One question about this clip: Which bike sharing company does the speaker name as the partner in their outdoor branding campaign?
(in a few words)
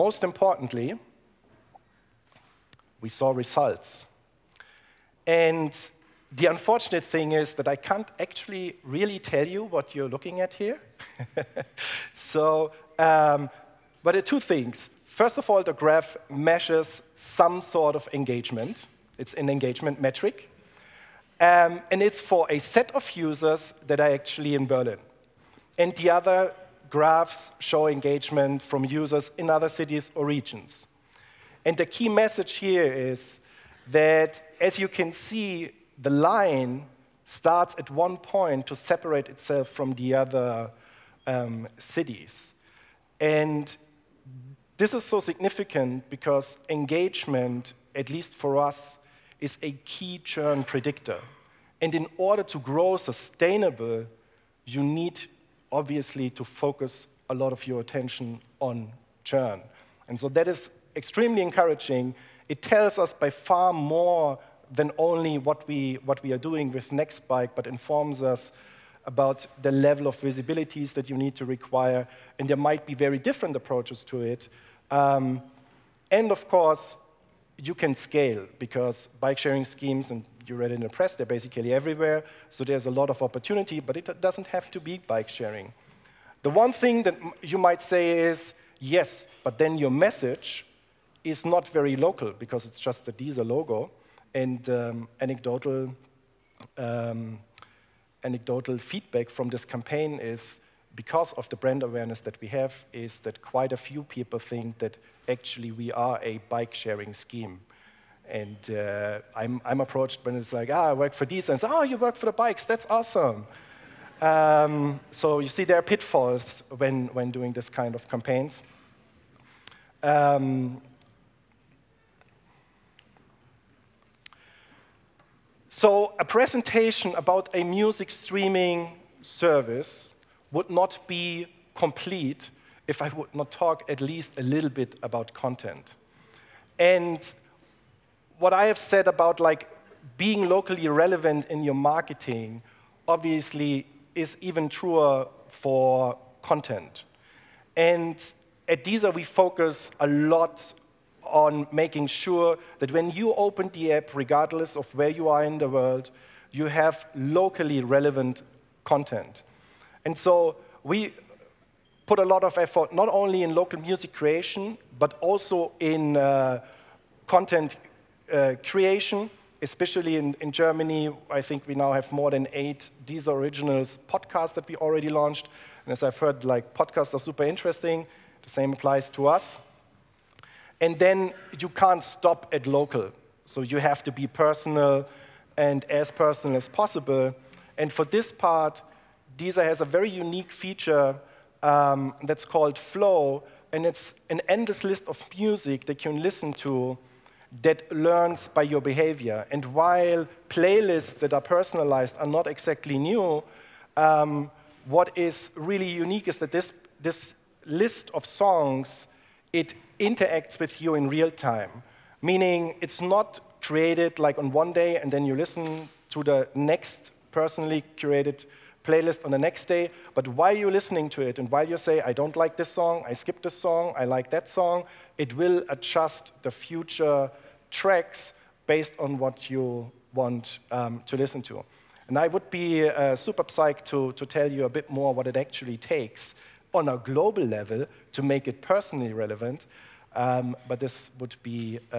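Nextbike.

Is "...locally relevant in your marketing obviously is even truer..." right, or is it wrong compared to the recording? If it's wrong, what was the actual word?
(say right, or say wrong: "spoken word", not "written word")
right.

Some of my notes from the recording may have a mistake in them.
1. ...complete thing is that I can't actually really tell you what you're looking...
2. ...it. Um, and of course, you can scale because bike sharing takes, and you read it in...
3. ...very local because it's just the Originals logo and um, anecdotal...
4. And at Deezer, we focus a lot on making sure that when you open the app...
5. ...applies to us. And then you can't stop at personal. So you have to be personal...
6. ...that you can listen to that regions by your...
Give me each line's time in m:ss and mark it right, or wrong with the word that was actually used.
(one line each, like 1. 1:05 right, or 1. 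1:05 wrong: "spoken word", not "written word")
1. 0:06 wrong: "unfortunate", not "complete"
2. 1:14 wrong: "schemes", not "takes"
3. 1:31 wrong: "Deezer", not "Originals"
4. 2:27 right
5. 2:58 wrong: "local", not "personal"
6. 3:15 wrong: "learns", not "regions".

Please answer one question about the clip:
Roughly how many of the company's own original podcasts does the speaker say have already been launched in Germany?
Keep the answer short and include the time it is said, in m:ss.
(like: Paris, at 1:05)
more than 8, at 2:52.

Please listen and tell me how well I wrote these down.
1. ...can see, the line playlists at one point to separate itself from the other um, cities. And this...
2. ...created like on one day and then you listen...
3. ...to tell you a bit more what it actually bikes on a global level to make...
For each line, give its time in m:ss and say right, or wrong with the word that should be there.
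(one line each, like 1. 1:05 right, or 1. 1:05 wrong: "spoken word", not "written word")
1. 0:34 wrong: "starts", not "playlists"
2. 3:33 right
3. 3:54 wrong: "takes", not "bikes".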